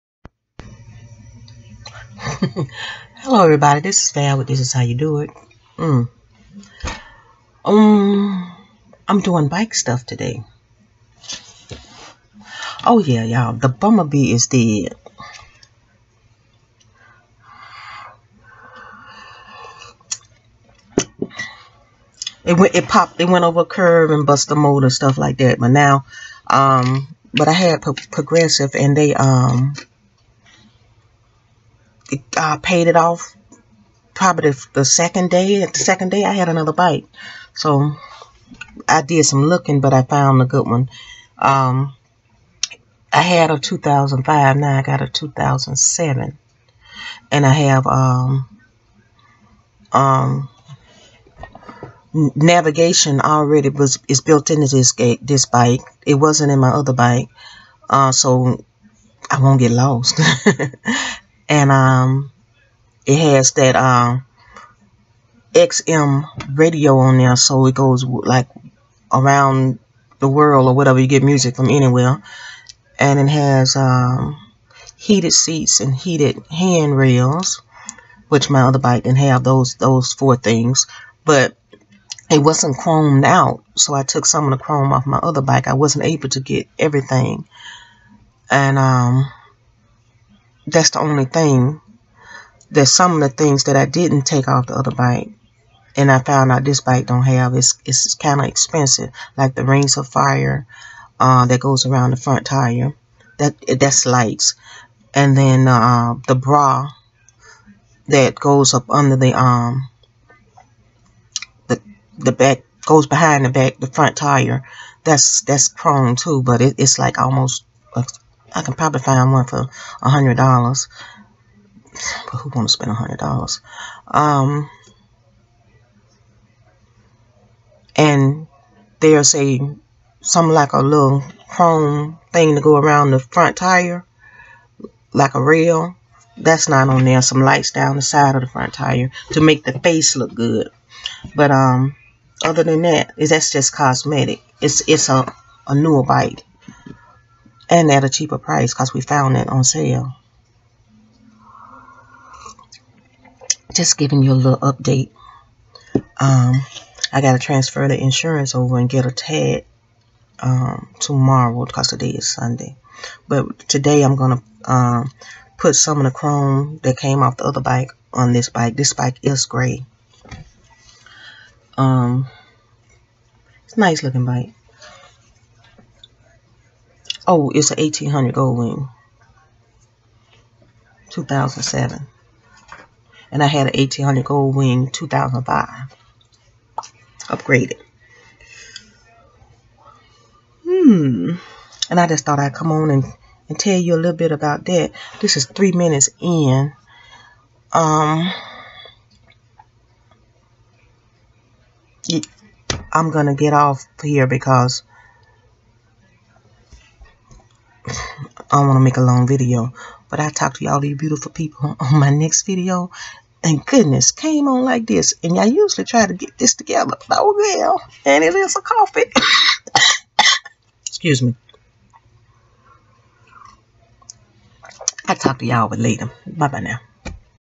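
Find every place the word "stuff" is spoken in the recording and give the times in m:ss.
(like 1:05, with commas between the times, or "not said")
0:09, 0:24.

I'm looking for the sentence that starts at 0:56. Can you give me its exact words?
It wasn't in my other bike, uh, so I won't get lost.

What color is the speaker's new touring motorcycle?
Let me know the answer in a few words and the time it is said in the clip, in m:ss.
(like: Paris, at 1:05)
Gray, at 2:49.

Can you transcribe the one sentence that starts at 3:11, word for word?
And I just thought I'd come on and, and tell you a little bit about that.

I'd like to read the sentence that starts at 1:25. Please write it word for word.
I wasn't able to get everything, and um that's the only thing.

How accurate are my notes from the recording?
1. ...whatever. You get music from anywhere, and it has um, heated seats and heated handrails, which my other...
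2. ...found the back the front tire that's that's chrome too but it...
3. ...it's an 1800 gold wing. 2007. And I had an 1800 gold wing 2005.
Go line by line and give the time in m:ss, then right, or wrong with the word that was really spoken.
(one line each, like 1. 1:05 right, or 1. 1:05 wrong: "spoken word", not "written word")
1. 1:10 right
2. 1:53 wrong: "behind", not "found"
3. 2:57 right.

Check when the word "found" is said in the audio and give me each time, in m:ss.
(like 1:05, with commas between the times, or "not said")
0:40, 1:36, 2:29.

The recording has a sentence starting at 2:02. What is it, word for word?
But who wants to spend a hundred dollars?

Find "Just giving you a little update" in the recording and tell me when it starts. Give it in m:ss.
2:33.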